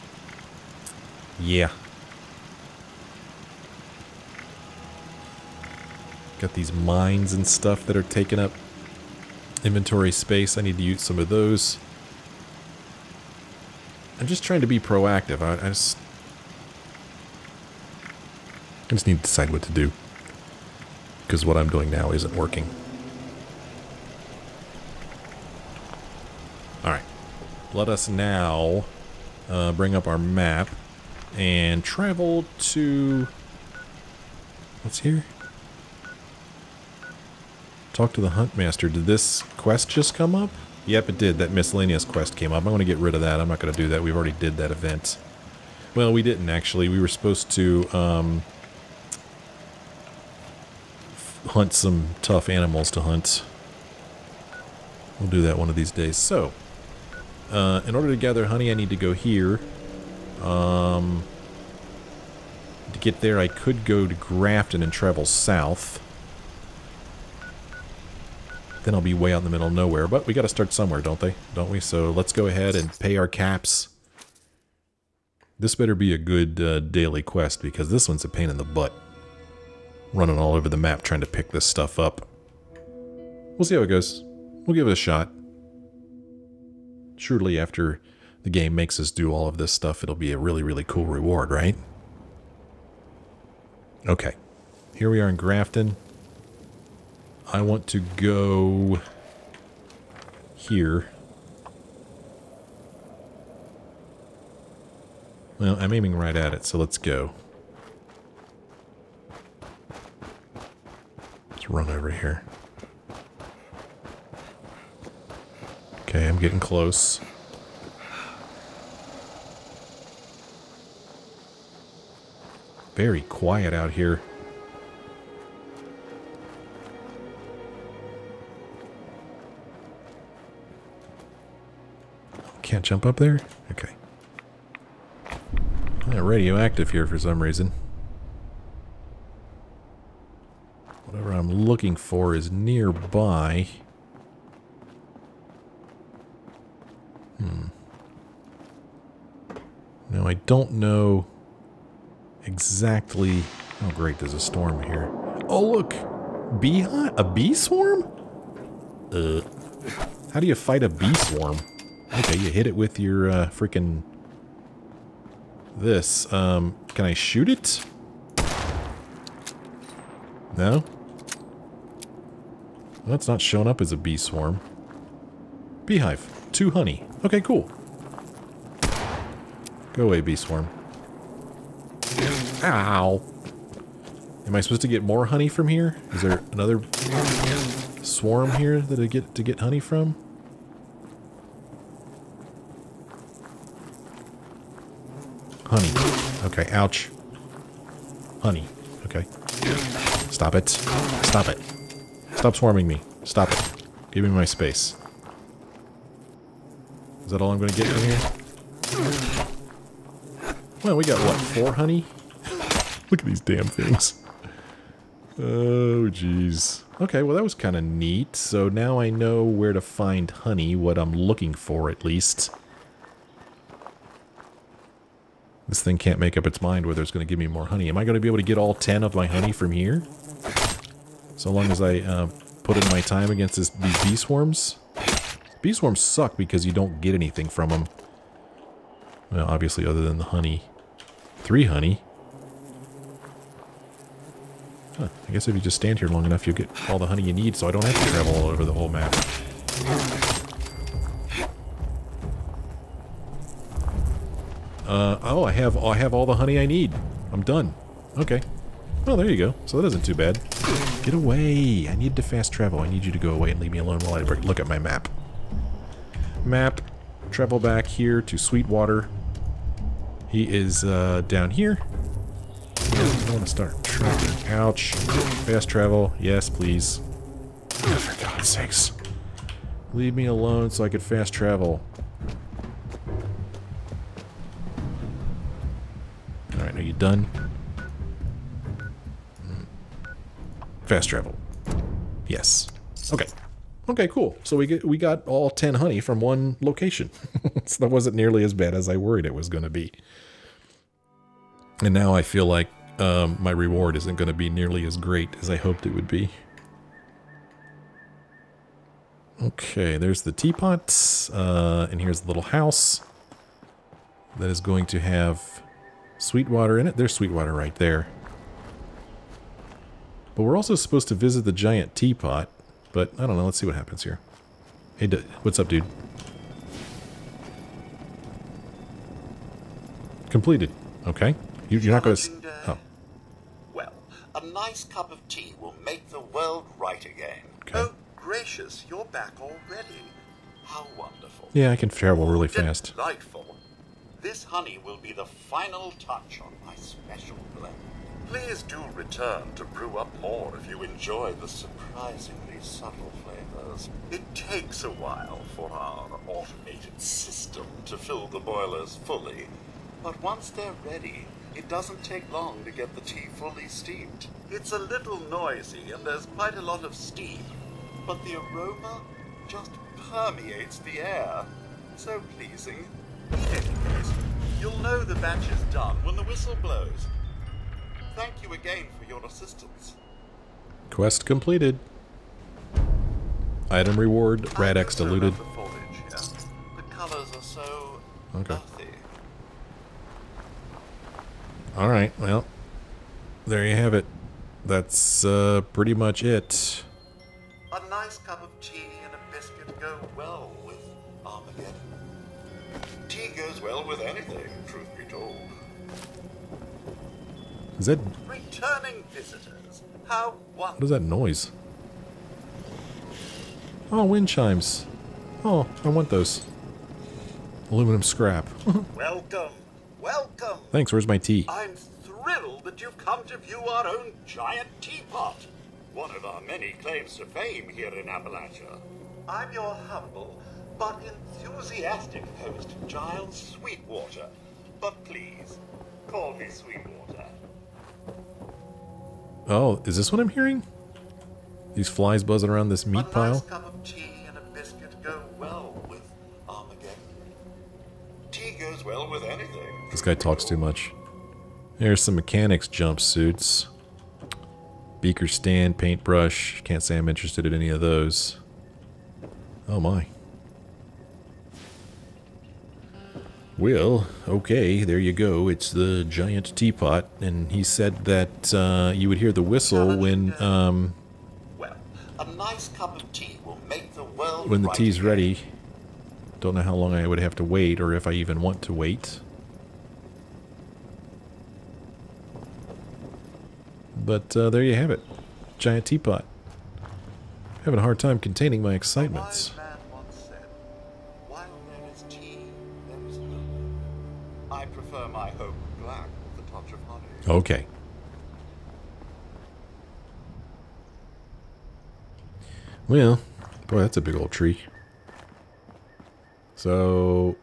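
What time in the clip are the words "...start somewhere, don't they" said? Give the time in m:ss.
1:10.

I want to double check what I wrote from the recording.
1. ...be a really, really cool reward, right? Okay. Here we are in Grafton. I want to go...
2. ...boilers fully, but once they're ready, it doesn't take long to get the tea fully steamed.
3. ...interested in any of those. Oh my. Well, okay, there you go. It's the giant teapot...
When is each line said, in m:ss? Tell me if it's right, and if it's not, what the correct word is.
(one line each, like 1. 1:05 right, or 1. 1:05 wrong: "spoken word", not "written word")
1. 1:30 right
2. 5:58 right
3. 7:37 right.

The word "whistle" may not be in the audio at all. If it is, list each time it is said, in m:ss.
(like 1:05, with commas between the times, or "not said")
6:16, 7:49.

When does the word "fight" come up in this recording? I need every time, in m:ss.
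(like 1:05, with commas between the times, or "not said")
2:40.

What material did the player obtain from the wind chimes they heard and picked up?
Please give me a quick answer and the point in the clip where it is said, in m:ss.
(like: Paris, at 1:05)
Aluminum scrap, at 6:57.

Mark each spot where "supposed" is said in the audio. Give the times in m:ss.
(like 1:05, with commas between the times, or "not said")
0:47, 3:04, 5:20.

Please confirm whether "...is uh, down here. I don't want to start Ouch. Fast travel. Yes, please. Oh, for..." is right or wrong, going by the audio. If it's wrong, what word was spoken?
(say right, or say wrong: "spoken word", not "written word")
right.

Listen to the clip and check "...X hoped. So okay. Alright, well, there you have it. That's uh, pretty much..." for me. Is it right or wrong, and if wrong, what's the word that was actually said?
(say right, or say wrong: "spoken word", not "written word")
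wrong: "diluted", not "hoped".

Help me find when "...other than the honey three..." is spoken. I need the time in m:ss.
3:59.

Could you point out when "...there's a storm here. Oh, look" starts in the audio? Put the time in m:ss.
2:34.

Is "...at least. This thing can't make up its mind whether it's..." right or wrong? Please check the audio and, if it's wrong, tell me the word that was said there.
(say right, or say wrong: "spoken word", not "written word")
right.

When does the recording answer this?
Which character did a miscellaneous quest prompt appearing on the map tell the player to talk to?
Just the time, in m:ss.
0:38.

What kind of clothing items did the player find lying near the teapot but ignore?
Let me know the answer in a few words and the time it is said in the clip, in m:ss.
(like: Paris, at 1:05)
mechanics jumpsuits, at 7:32.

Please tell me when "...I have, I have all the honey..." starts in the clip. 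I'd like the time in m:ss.
4:15.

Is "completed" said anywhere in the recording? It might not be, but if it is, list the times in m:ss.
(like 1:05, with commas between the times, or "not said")
5:30, 6:21.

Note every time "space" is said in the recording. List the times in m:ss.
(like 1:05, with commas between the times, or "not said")
0:10, 3:24.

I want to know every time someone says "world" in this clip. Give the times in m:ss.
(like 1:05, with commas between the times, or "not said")
5:36, 7:54.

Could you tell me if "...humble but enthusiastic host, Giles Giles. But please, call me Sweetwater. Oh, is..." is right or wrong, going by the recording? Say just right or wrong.
wrong.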